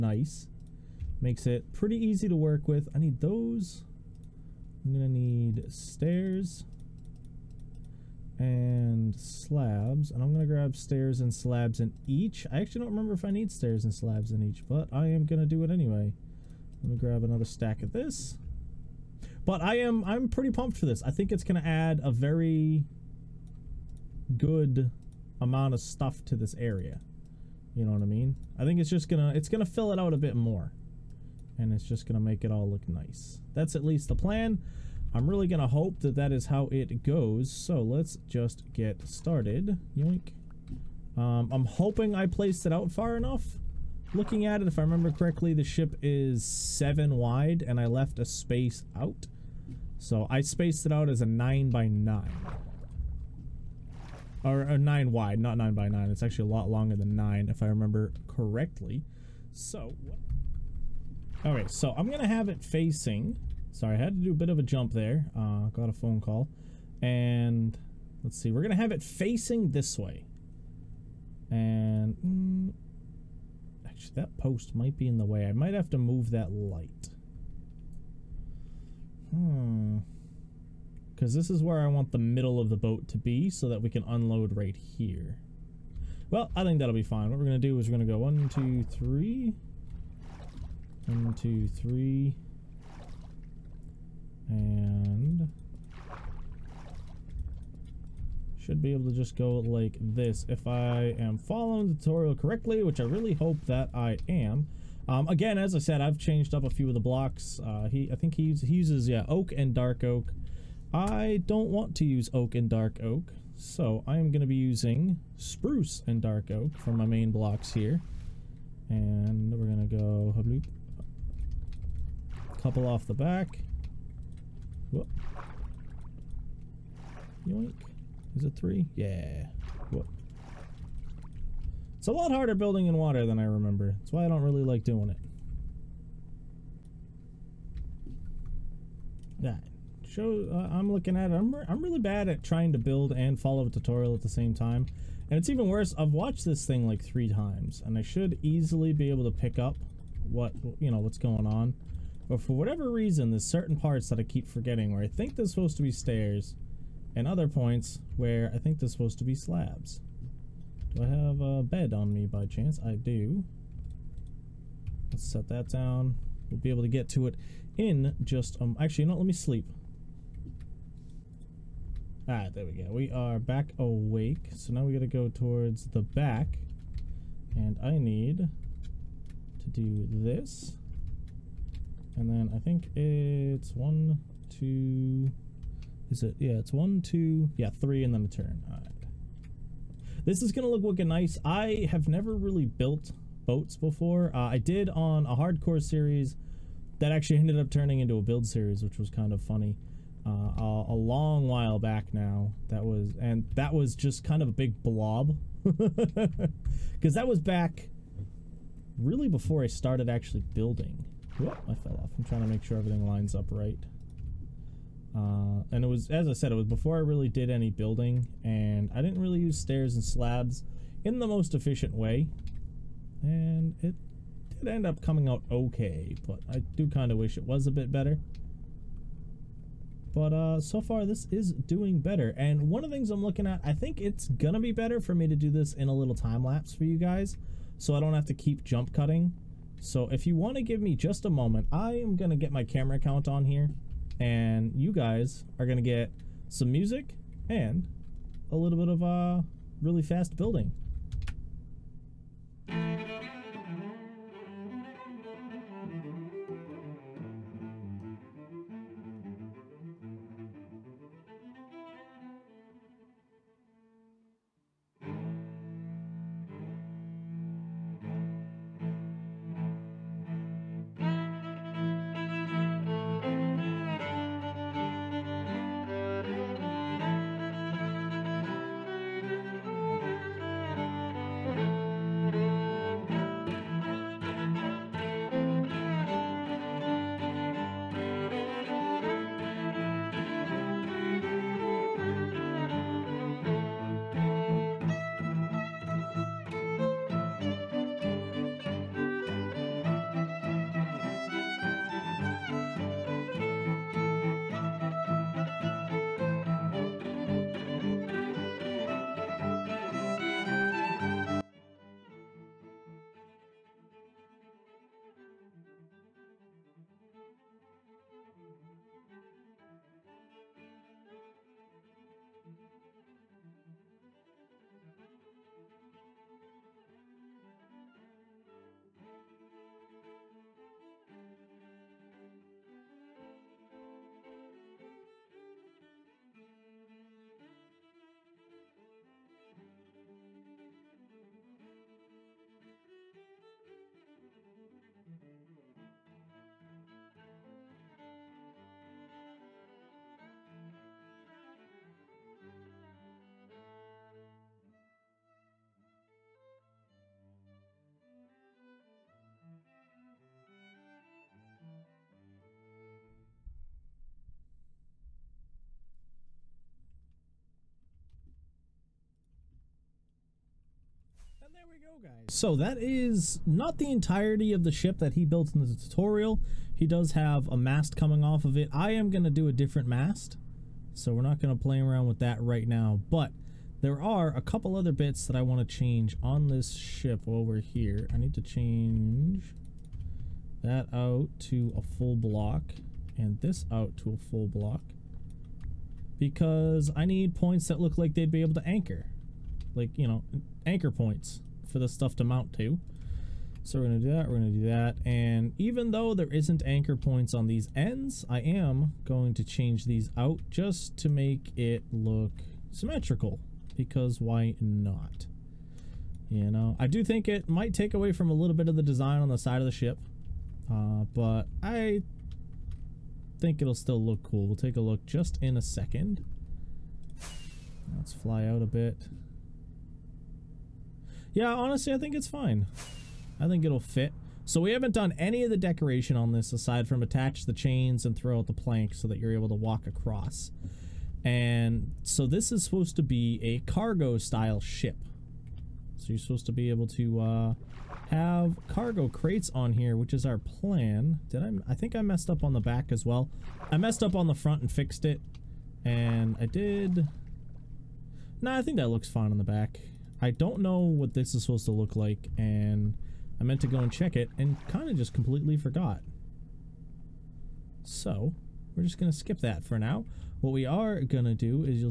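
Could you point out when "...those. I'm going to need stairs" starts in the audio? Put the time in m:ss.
0:03.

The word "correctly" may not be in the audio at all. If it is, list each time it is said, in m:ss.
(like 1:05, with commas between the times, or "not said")
0:45, 0:58, 1:42.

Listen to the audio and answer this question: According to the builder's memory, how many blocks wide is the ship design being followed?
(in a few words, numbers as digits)
7.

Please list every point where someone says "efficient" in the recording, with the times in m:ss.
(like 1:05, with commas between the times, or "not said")
3:41.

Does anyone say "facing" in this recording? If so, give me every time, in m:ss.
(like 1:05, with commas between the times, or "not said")
1:02, 1:09.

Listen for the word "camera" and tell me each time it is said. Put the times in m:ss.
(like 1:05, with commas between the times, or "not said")
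4:02.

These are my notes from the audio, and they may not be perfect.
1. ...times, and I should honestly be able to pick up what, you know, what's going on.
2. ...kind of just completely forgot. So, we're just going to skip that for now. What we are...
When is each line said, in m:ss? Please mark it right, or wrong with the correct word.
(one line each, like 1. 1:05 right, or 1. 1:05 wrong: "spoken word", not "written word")
1. 2:27 wrong: "easily", not "honestly"
2. 7:44 right.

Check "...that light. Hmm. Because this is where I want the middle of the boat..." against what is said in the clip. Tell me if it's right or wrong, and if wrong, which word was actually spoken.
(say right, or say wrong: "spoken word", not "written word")
right.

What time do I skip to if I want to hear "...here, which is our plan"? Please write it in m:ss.
7:29.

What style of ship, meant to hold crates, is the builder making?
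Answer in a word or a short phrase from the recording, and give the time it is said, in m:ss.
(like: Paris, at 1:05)
Cargo style, at 7:23.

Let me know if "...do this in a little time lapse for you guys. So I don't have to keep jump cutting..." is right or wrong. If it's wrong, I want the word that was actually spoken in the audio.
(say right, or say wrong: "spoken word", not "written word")
right.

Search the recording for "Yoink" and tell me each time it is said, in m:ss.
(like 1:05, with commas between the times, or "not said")
0:39, 2:07.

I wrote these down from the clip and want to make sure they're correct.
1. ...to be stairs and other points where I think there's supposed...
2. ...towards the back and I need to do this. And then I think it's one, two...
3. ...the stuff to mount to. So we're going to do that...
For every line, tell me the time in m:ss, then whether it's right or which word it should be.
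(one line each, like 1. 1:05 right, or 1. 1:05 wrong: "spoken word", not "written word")
1. 2:35 right
2. 2:55 right
3. 6:41 right.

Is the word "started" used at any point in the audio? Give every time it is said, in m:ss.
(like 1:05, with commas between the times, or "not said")
0:39, 3:29.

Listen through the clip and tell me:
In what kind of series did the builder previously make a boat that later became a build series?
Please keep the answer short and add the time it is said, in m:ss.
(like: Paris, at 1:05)
Hardcore series, at 3:15.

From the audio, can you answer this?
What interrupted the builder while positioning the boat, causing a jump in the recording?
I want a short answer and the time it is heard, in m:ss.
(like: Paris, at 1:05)
A phone call, at 1:05.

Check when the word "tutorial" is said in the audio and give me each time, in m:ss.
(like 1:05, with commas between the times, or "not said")
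1:41, 2:23, 6:15.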